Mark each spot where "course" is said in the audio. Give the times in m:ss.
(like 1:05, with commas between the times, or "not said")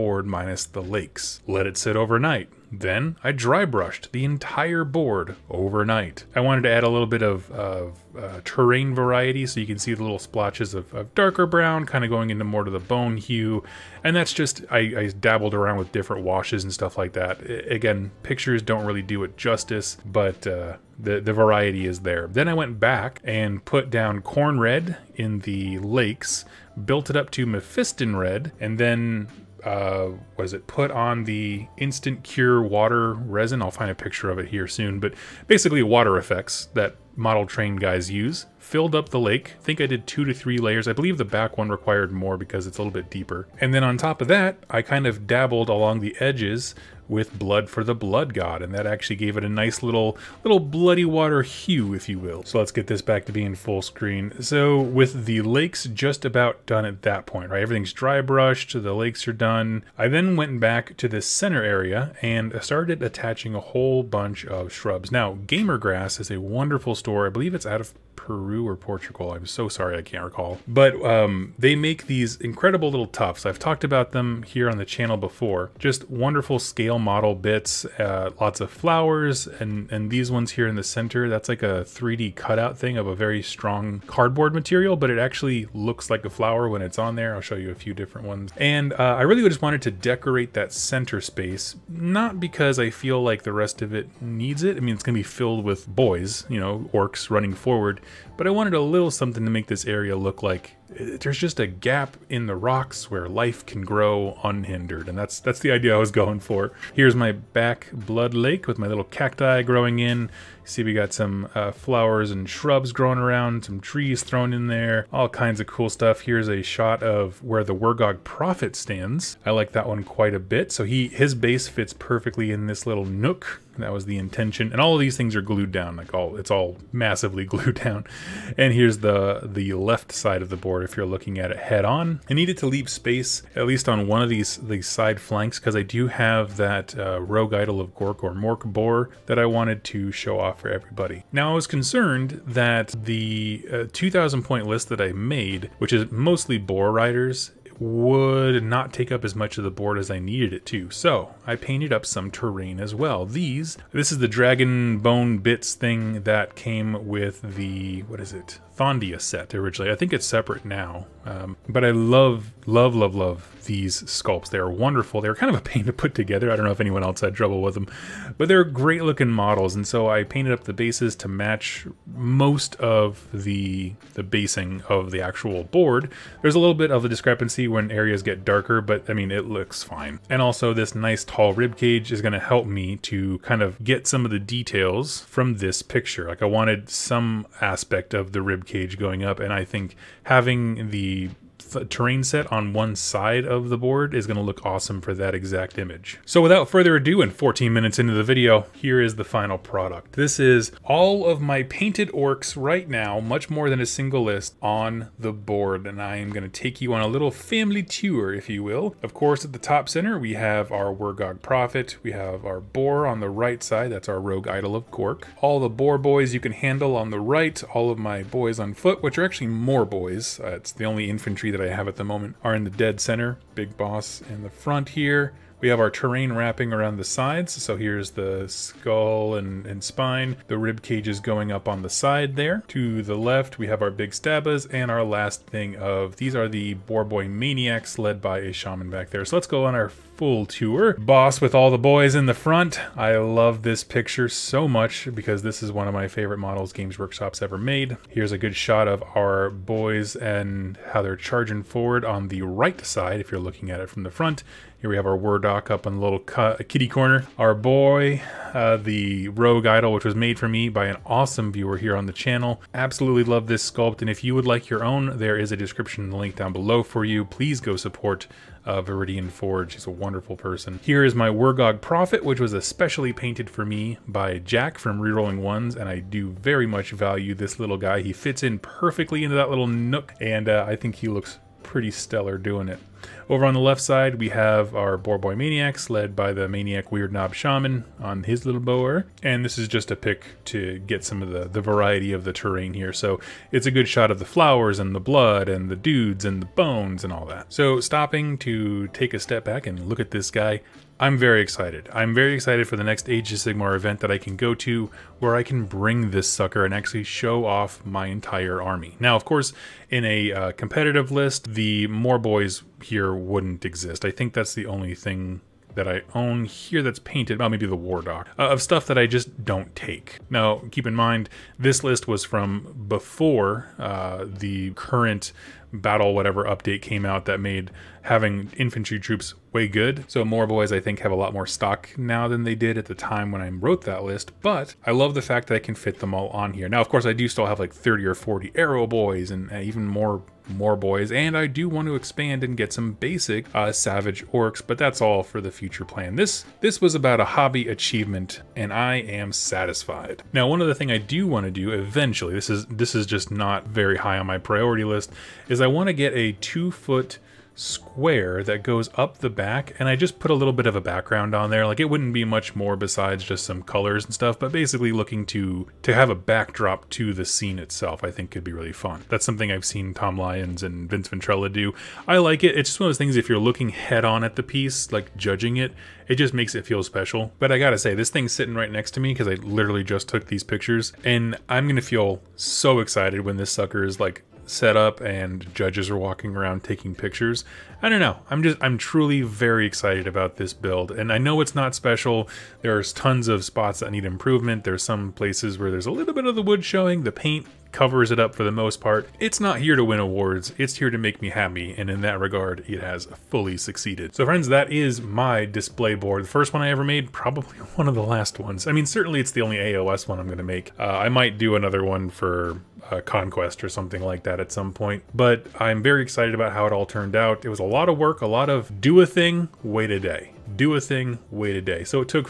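3:29, 5:09, 5:36.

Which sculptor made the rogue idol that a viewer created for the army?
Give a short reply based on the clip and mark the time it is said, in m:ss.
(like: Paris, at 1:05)
Viridian Forge, at 4:28.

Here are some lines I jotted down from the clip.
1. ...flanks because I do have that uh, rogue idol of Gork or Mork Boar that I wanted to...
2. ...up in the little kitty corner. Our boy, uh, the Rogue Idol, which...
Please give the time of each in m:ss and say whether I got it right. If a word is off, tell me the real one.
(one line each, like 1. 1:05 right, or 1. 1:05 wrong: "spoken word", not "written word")
1. 2:15 right
2. 4:15 right.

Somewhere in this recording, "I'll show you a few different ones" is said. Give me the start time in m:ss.
1:27.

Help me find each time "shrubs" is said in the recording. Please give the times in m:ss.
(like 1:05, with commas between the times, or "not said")
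1:04, 1:52.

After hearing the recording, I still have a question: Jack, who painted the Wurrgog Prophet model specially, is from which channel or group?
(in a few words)
Rerolling Ones.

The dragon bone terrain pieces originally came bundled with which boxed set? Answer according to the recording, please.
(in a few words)
Thondia.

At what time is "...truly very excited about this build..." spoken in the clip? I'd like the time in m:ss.
6:28.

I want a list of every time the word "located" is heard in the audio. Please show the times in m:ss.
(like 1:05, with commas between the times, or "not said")
not said.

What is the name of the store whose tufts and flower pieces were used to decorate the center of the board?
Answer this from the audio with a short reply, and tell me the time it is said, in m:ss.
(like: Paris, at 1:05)
Gamer Grass, at 1:05.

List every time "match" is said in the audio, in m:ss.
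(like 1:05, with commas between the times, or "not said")
2:51.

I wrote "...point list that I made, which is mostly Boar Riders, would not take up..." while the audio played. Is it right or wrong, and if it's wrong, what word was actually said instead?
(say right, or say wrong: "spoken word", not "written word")
right.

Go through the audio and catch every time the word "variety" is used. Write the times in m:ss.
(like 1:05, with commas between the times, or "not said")
0:08, 0:21, 4:51.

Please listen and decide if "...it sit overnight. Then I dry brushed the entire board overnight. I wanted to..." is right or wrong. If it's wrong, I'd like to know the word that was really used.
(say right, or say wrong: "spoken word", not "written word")
right.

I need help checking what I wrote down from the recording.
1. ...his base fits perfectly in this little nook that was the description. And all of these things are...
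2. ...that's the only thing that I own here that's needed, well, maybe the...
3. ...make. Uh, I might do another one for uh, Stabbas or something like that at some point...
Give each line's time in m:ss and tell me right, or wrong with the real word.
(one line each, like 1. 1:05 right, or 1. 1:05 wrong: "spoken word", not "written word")
1. 2:01 wrong: "intention", not "description"
2. 5:14 wrong: "painted", not "needed"
3. 6:50 wrong: "Conquest", not "Stabbas".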